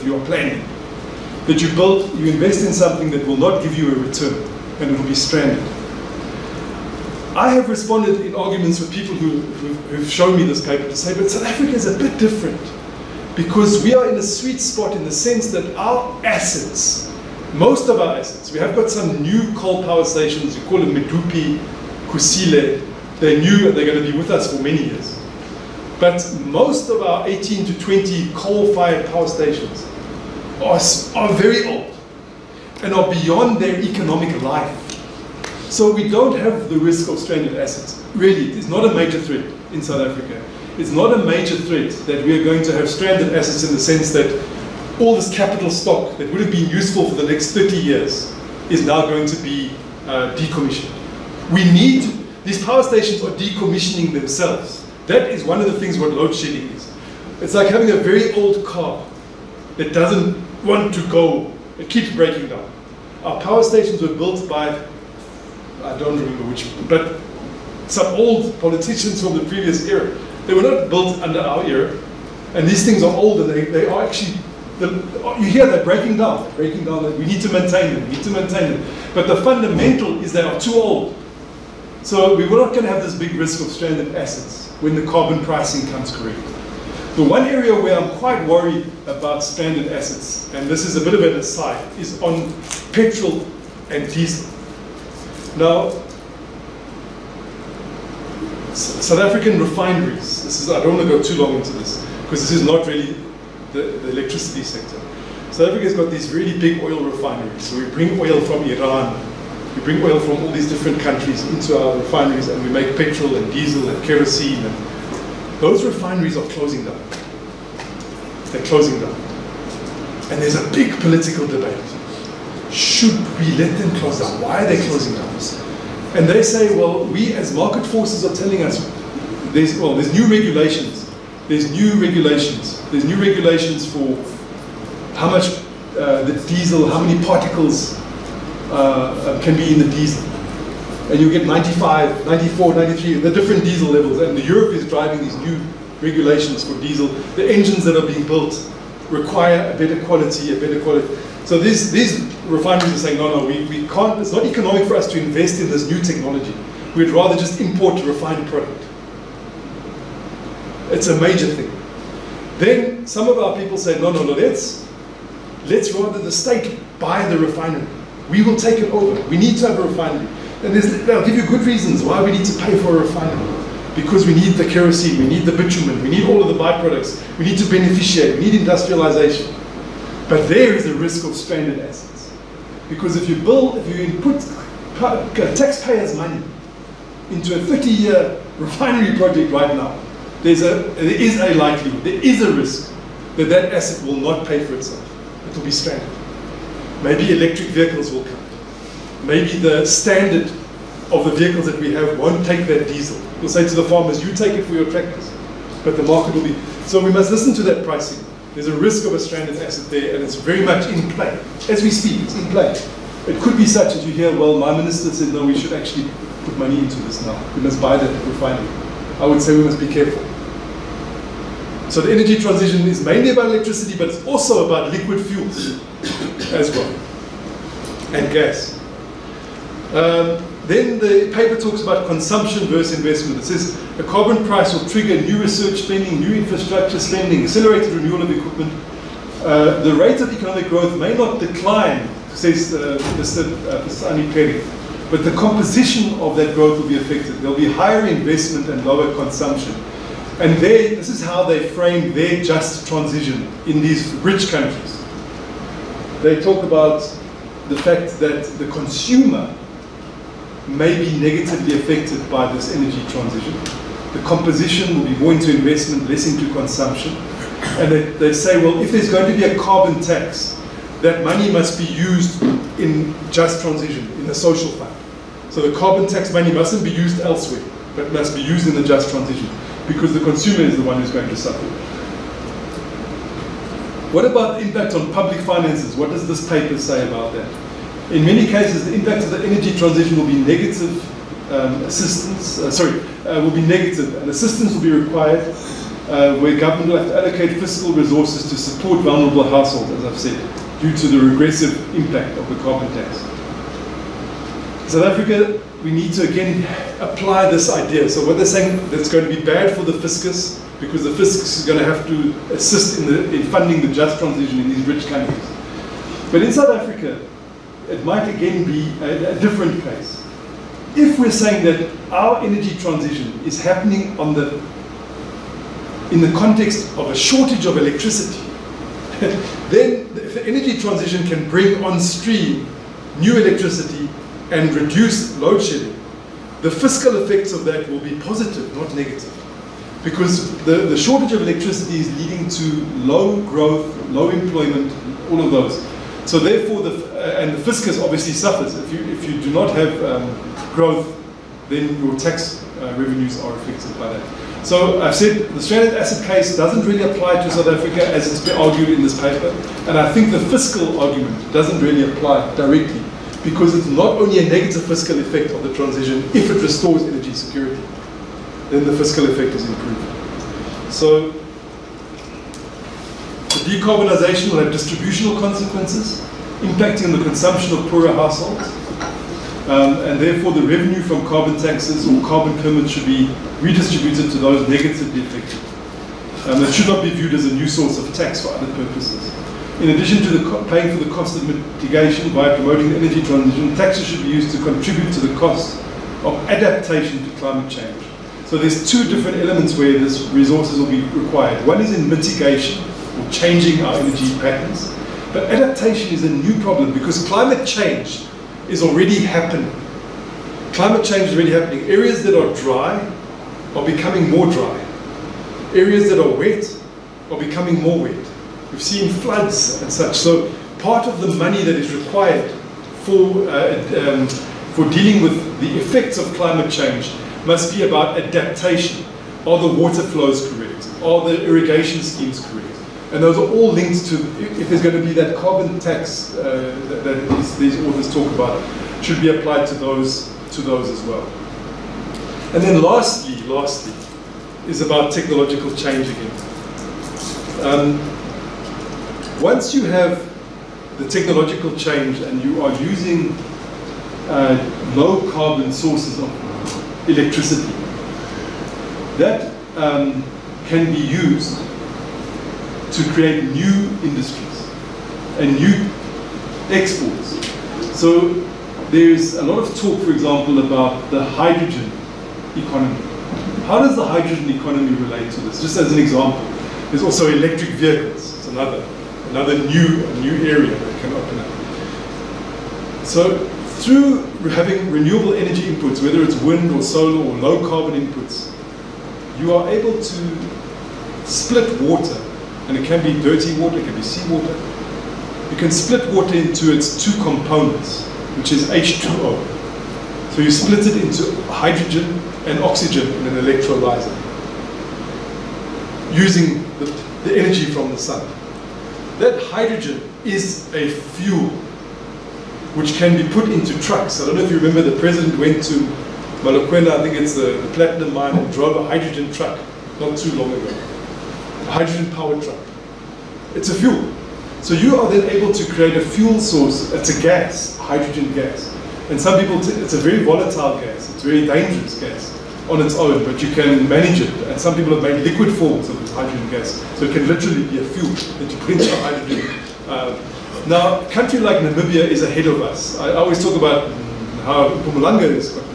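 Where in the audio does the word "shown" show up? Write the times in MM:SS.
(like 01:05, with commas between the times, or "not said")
00:10.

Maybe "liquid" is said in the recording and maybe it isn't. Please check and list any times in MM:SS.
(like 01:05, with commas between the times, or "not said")
03:44, 08:55.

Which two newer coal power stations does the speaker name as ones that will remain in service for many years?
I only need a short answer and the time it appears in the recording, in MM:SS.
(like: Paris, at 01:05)
Medupi, Kusile, at 00:20.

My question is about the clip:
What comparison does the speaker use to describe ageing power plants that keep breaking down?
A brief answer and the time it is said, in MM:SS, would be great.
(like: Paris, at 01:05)
A very old car, at 00:57.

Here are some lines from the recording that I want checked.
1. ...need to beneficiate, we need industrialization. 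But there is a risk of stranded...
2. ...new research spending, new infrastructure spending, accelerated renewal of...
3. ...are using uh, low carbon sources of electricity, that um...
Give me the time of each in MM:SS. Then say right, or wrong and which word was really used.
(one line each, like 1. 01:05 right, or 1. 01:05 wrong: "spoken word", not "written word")
1. 02:57 right
2. 03:55 right
3. 07:32 right.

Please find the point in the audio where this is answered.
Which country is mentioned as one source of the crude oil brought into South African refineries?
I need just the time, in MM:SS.
01:48.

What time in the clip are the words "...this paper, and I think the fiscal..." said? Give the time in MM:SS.
05:59.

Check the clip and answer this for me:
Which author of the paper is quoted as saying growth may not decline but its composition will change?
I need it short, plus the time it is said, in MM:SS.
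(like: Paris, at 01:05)
Pisani Peri, at 04:03.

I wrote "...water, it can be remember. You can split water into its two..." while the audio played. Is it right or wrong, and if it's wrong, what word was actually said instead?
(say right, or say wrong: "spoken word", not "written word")
wrong: "seawater", not "remember".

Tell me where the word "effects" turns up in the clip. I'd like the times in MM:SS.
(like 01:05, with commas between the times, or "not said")
05:37, 06:05, 06:09, 07:05.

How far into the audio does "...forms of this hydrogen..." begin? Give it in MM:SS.
08:55.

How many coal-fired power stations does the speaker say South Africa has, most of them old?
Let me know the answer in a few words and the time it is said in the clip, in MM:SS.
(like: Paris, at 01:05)
18 to 20, at 00:27.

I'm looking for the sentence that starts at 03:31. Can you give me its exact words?
As we speak, it's in play.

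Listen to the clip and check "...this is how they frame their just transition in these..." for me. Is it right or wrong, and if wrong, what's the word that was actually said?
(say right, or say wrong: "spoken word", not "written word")
right.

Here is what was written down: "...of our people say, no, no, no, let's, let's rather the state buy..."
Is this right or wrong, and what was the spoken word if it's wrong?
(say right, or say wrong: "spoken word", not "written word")
right.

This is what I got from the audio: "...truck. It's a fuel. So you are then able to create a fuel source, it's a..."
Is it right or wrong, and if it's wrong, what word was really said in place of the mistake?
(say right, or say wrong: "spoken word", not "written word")
right.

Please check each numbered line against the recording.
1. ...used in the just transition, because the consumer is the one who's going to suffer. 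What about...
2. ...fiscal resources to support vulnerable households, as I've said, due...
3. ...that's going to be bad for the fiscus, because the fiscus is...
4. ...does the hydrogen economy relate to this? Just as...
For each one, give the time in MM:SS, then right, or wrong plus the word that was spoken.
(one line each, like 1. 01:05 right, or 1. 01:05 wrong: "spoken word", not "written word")
1. 04:38 right
2. 04:57 right
3. 05:08 right
4. 07:53 right.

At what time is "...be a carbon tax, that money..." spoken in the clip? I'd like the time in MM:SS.
04:29.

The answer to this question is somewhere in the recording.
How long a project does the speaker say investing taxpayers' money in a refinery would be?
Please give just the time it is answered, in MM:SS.
03:07.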